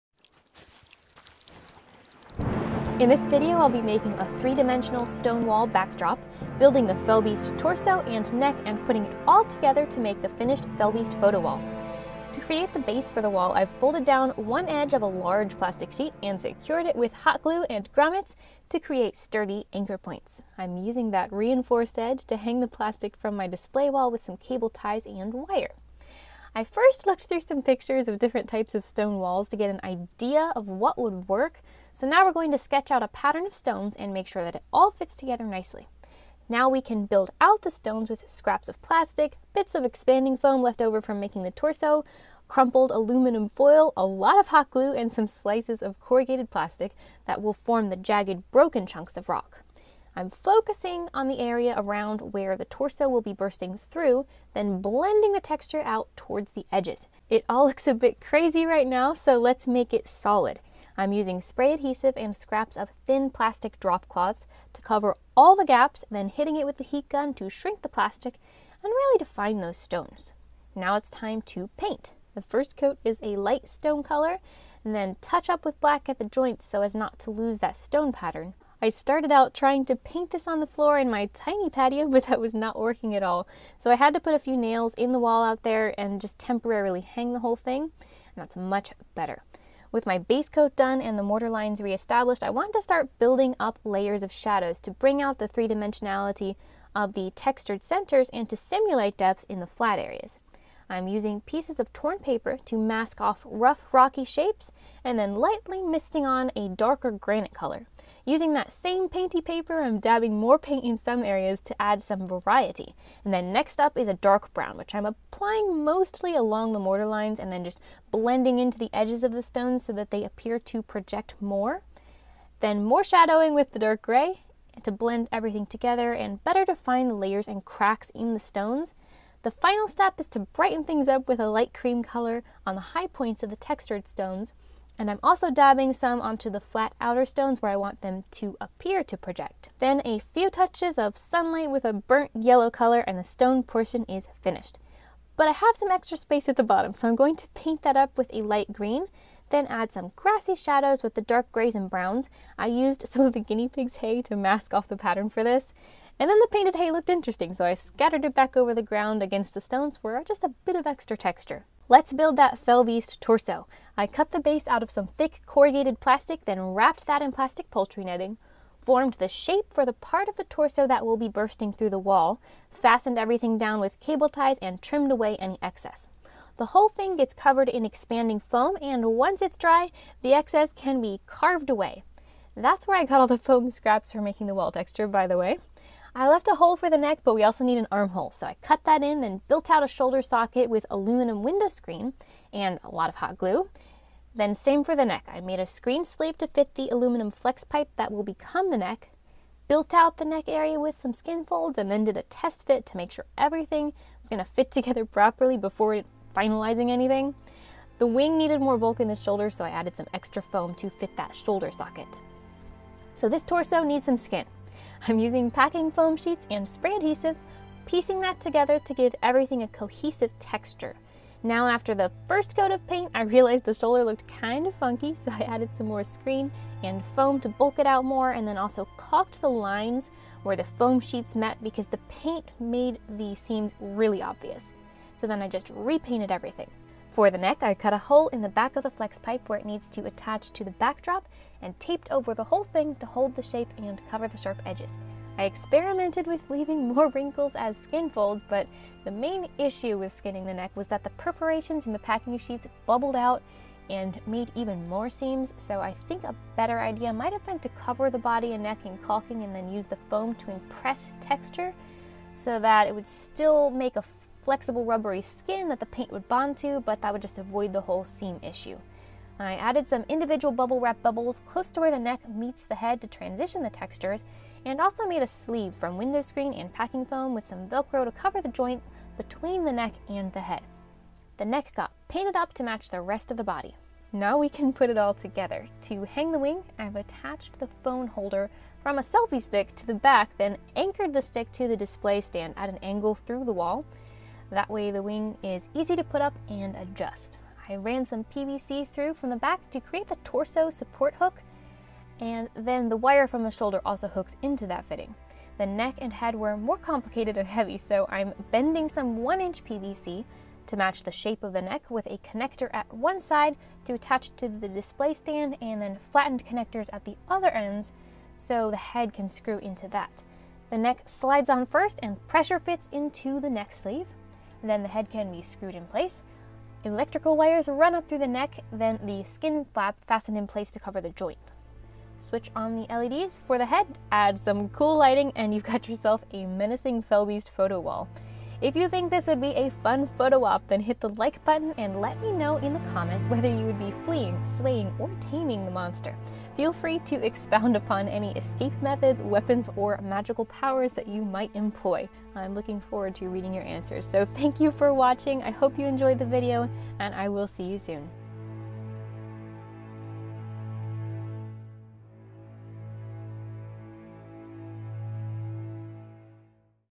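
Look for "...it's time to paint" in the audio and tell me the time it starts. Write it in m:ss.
1:10.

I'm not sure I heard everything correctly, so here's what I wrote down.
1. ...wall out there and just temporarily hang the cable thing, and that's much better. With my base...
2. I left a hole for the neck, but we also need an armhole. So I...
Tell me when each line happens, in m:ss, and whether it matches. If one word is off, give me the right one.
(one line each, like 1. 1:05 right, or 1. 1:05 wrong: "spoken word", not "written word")
1. 1:25 wrong: "whole", not "cable"
2. 3:06 right.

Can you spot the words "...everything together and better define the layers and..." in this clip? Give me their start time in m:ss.
2:05.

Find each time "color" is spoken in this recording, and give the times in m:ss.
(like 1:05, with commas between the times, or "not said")
1:14, 1:47, 2:12, 2:22.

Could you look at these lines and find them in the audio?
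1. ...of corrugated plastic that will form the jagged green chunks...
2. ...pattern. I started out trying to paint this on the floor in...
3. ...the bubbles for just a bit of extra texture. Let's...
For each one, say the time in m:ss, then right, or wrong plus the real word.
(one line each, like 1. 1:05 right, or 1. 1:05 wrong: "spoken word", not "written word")
1. 0:45 wrong: "broken", not "green"
2. 1:18 right
3. 2:39 wrong: "stones", not "bubbles".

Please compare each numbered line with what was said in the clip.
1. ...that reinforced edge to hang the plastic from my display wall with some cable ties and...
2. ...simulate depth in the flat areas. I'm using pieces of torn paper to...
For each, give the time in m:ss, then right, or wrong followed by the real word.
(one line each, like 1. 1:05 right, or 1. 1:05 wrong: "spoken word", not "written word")
1. 0:21 right
2. 1:38 right.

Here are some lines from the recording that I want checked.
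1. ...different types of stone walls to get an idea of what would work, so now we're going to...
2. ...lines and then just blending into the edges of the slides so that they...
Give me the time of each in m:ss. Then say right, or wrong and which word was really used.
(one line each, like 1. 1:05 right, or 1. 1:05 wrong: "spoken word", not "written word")
1. 0:28 right
2. 1:57 wrong: "stones", not "slides".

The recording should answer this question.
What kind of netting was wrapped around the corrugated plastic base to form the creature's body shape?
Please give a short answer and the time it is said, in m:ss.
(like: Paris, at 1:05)
poultry netting, at 2:47.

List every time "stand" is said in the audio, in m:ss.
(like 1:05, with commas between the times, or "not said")
4:52, 5:15.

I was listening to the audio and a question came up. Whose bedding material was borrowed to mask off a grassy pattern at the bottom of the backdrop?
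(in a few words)
the guinea pig's hay.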